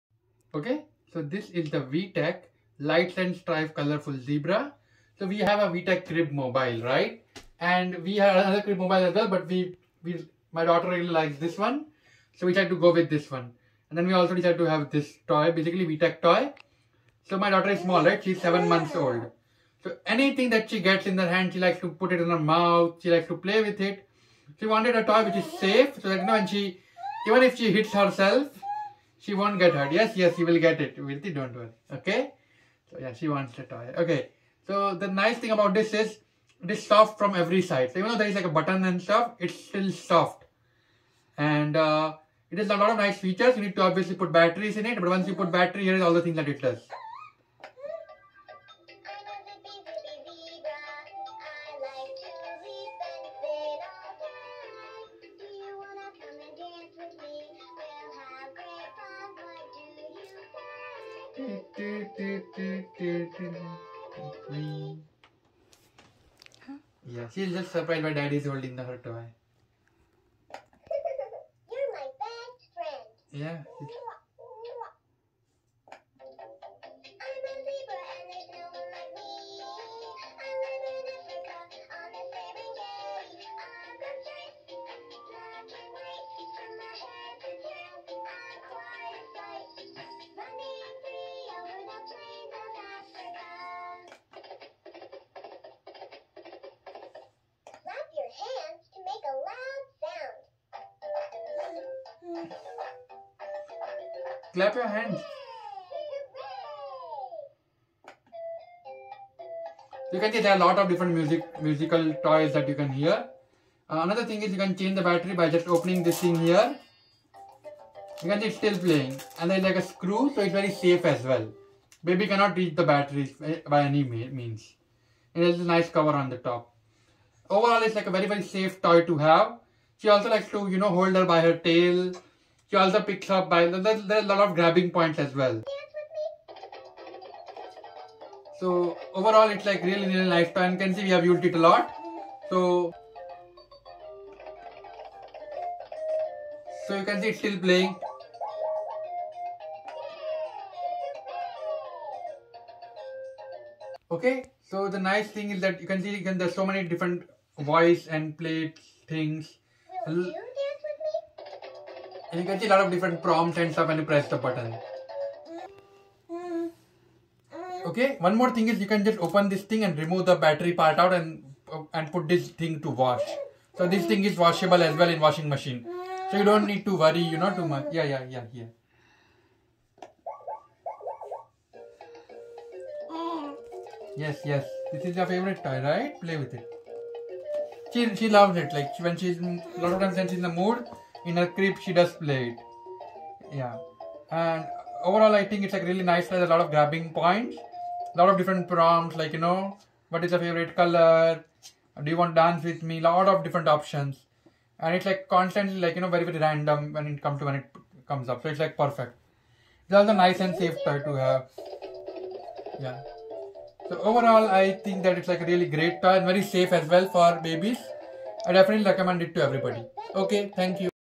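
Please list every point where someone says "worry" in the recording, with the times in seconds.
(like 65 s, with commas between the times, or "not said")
31 s, 176 s.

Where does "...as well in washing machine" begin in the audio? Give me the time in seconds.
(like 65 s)
174 s.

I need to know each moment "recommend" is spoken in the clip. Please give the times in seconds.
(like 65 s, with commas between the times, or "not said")
218 s.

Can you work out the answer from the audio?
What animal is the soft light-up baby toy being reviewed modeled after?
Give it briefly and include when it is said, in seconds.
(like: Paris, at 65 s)
Zebra, at 3 s.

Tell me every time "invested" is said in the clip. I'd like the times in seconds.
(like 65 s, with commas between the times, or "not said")
not said.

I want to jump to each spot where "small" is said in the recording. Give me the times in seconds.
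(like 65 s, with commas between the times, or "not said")
17 s.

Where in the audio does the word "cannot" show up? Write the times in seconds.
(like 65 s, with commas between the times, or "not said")
122 s.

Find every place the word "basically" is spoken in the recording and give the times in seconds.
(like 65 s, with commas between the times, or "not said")
15 s.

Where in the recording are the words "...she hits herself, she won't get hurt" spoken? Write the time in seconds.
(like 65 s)
27 s.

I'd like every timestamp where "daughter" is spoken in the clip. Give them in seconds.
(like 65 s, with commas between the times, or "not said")
10 s, 17 s.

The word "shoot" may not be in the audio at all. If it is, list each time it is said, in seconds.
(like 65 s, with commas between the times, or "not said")
not said.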